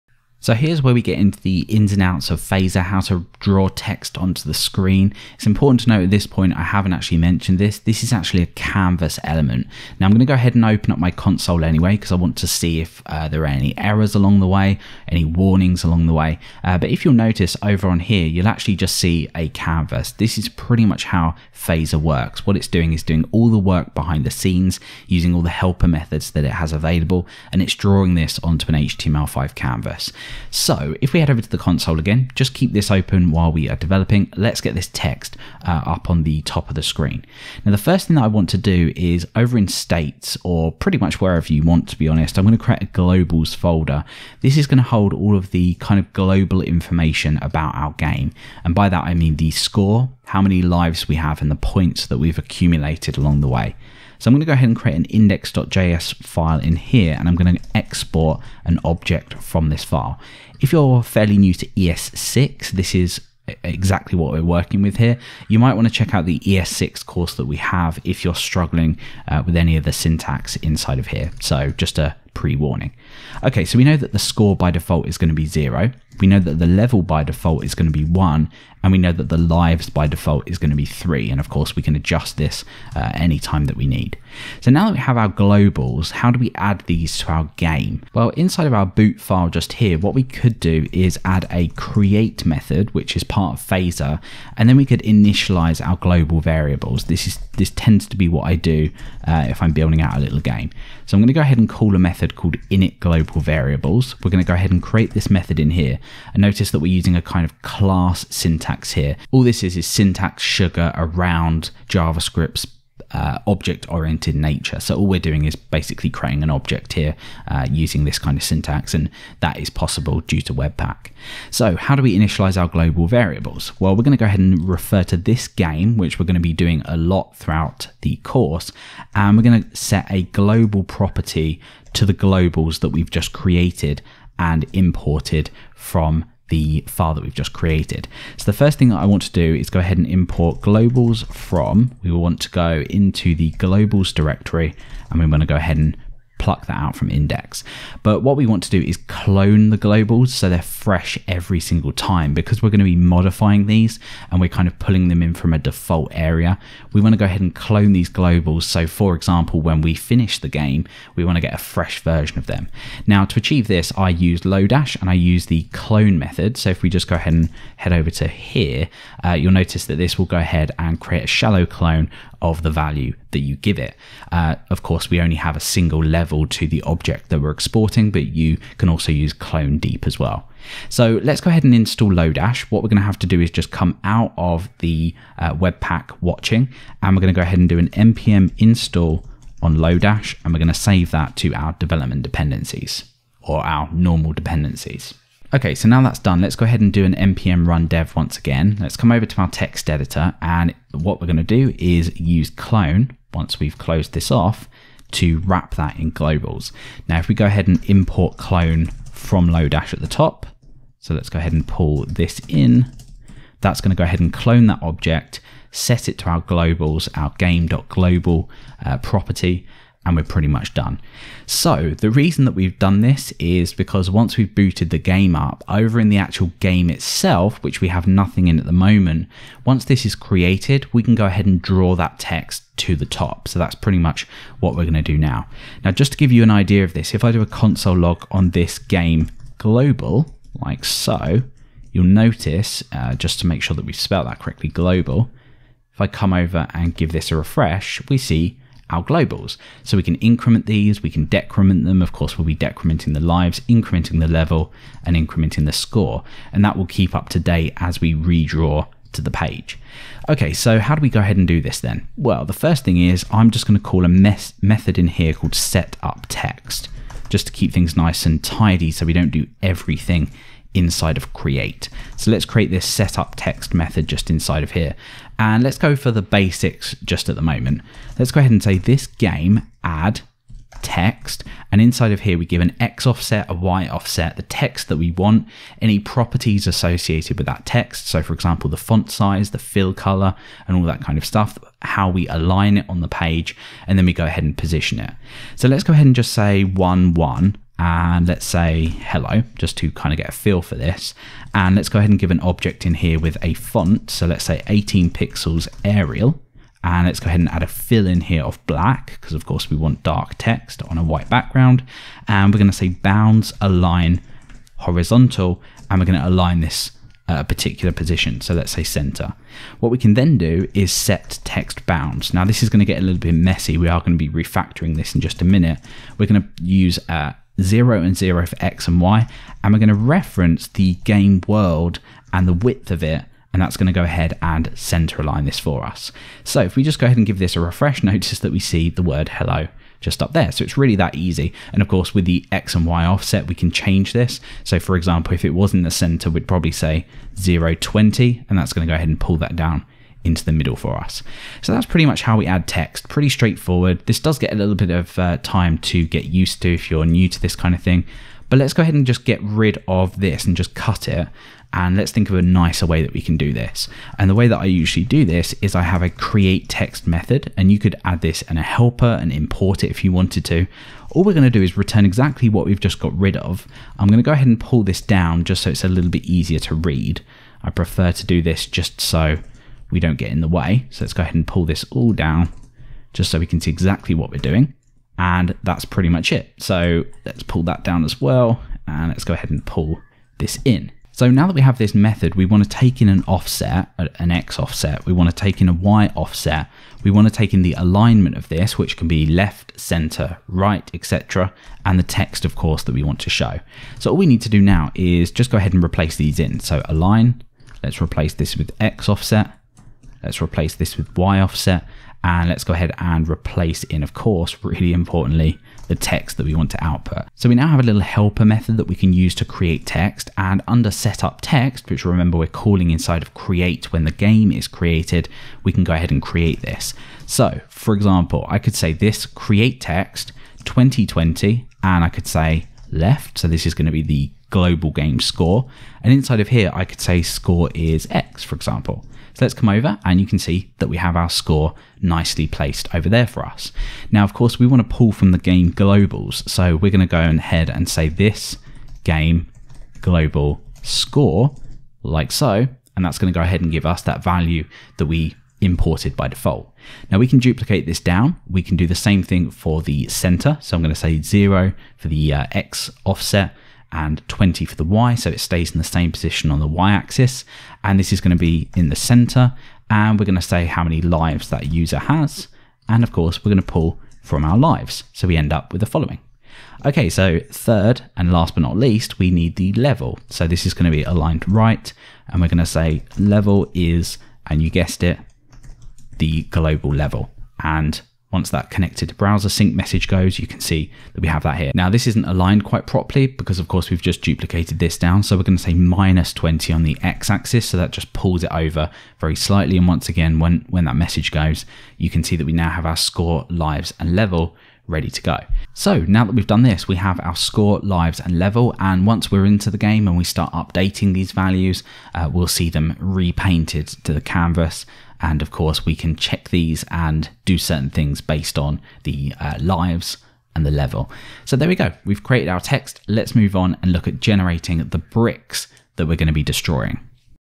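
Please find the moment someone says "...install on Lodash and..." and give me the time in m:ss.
3:08.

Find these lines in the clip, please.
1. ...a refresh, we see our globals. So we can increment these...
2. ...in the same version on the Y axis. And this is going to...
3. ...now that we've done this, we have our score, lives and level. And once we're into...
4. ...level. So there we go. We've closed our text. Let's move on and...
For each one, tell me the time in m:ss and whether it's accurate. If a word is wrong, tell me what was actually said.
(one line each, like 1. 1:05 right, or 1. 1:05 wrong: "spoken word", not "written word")
1. 4:07 right
2. 7:45 wrong: "position", not "version"
3. 8:26 right
4. 8:40 wrong: "created", not "closed".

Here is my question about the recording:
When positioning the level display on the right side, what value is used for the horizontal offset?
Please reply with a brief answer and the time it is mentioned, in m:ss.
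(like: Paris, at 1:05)
-20, at 8:15.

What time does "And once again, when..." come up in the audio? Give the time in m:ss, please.
8:19.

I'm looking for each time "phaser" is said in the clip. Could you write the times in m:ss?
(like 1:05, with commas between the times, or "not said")
0:02, 0:21, 1:33.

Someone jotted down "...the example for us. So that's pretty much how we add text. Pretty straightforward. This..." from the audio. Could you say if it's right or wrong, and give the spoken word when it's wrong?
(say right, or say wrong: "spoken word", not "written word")
wrong: "middle", not "example".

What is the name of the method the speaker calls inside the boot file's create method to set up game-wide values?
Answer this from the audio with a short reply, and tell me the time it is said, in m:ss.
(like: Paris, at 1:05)
init global variables, at 1:42.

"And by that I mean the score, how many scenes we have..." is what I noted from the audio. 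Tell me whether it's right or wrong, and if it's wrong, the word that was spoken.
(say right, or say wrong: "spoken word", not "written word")
wrong: "lives", not "scenes".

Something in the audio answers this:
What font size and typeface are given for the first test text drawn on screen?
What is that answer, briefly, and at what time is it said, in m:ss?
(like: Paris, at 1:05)
18 pixels Arial, at 5:04.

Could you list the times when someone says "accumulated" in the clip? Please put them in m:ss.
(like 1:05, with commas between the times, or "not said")
0:52.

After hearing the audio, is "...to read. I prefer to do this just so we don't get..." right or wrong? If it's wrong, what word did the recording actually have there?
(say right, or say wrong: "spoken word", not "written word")
right.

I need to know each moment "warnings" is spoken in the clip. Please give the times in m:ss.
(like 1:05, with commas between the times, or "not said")
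0:15, 1:12.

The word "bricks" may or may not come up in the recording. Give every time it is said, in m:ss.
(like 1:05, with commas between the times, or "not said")
8:44.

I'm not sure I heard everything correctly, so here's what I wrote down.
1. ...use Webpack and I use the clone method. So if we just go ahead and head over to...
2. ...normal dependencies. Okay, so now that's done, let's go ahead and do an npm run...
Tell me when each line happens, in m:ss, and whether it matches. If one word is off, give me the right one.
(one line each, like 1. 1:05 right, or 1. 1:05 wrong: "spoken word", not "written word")
1. 2:44 wrong: "Lodash", not "Webpack"
2. 3:13 right.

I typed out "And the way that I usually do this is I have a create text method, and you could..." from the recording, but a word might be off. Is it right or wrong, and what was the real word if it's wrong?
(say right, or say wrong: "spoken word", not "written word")
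right.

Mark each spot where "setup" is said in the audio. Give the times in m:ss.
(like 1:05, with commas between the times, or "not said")
4:32, 7:00.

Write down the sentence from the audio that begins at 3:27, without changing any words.
Now if we go ahead and import clone from Lodash at the top.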